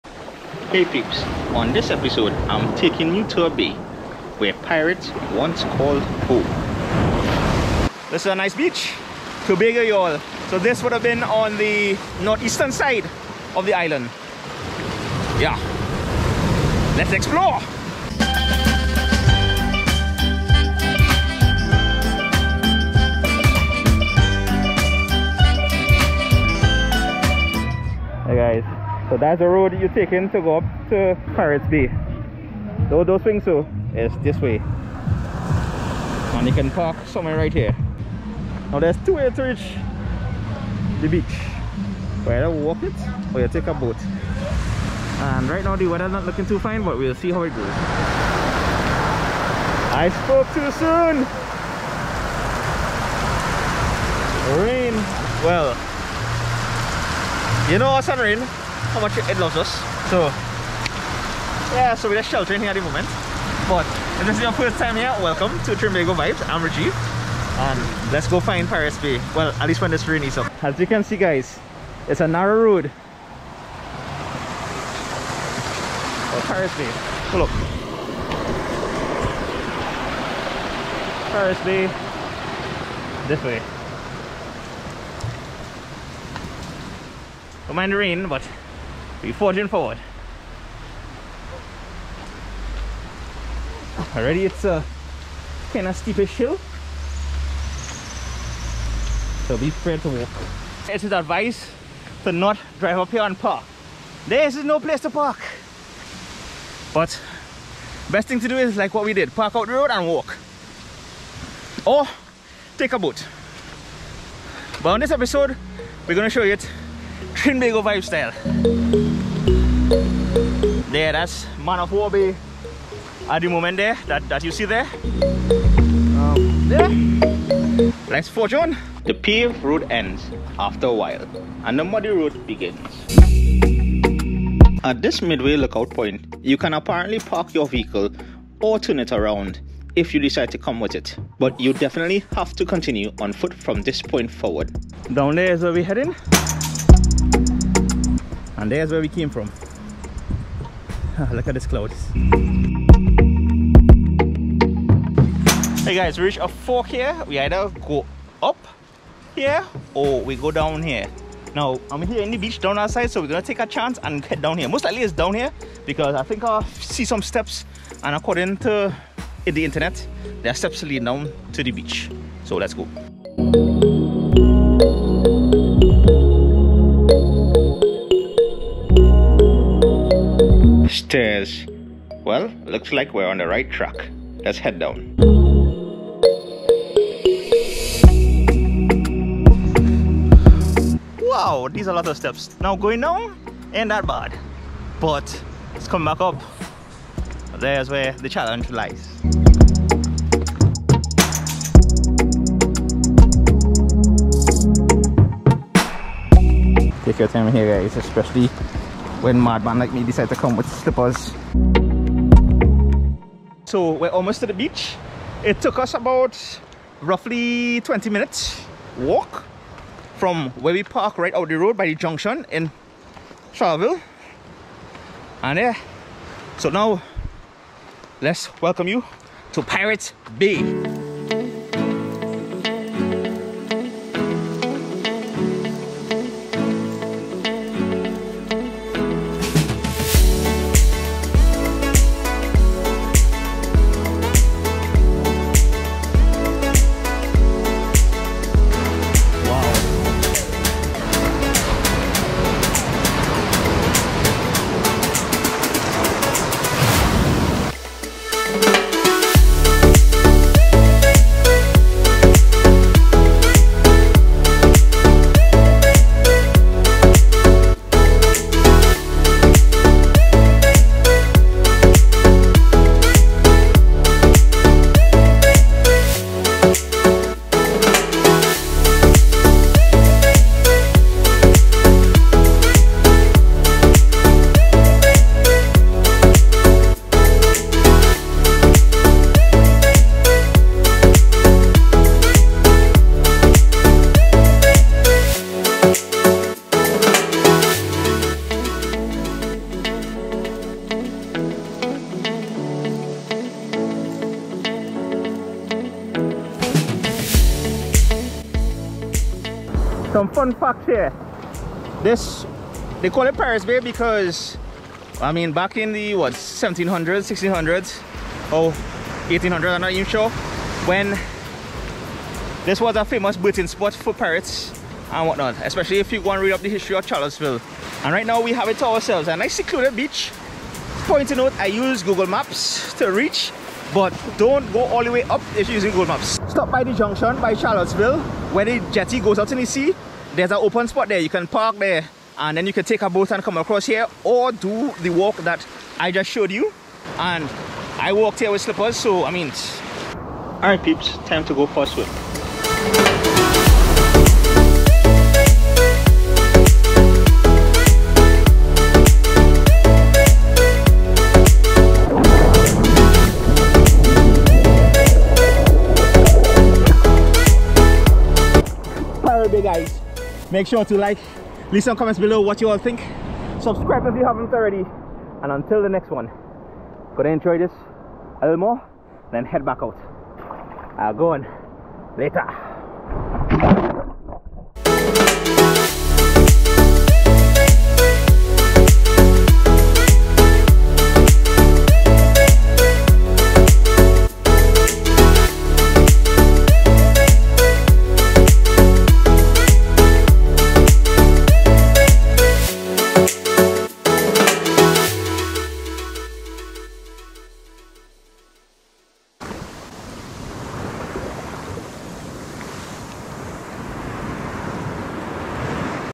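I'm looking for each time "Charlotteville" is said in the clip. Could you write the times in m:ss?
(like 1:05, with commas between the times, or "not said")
3:43, 5:27, 5:37.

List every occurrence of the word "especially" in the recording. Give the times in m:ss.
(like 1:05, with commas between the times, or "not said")
3:27, 5:25.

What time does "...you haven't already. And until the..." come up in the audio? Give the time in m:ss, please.
6:14.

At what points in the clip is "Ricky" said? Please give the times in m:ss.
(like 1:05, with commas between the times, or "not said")
not said.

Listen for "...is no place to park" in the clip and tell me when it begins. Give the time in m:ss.
1:44.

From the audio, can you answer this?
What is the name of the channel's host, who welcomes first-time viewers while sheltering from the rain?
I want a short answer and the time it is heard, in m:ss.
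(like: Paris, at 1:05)
Rajiv, at 1:06.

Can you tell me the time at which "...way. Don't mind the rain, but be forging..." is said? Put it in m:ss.
1:23.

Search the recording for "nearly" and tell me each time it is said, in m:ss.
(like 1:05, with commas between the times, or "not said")
not said.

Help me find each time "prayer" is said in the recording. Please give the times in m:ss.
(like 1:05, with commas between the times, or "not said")
not said.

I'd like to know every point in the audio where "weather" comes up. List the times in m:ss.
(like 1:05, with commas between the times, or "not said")
0:45.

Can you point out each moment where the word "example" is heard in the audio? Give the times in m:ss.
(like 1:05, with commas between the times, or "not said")
not said.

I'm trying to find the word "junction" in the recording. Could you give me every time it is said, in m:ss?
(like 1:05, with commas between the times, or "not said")
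3:41, 5:36.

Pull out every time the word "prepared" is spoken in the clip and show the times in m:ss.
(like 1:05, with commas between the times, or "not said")
1:39.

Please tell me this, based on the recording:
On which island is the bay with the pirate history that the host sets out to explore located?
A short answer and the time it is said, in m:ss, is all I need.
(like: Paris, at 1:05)
Tobago, at 0:09.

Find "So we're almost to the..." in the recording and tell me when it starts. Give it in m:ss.
3:33.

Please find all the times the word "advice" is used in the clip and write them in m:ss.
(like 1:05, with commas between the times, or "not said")
1:41.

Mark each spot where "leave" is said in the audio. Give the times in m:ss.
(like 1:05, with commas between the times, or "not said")
6:11.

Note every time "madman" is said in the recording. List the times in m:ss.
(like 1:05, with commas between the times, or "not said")
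3:29.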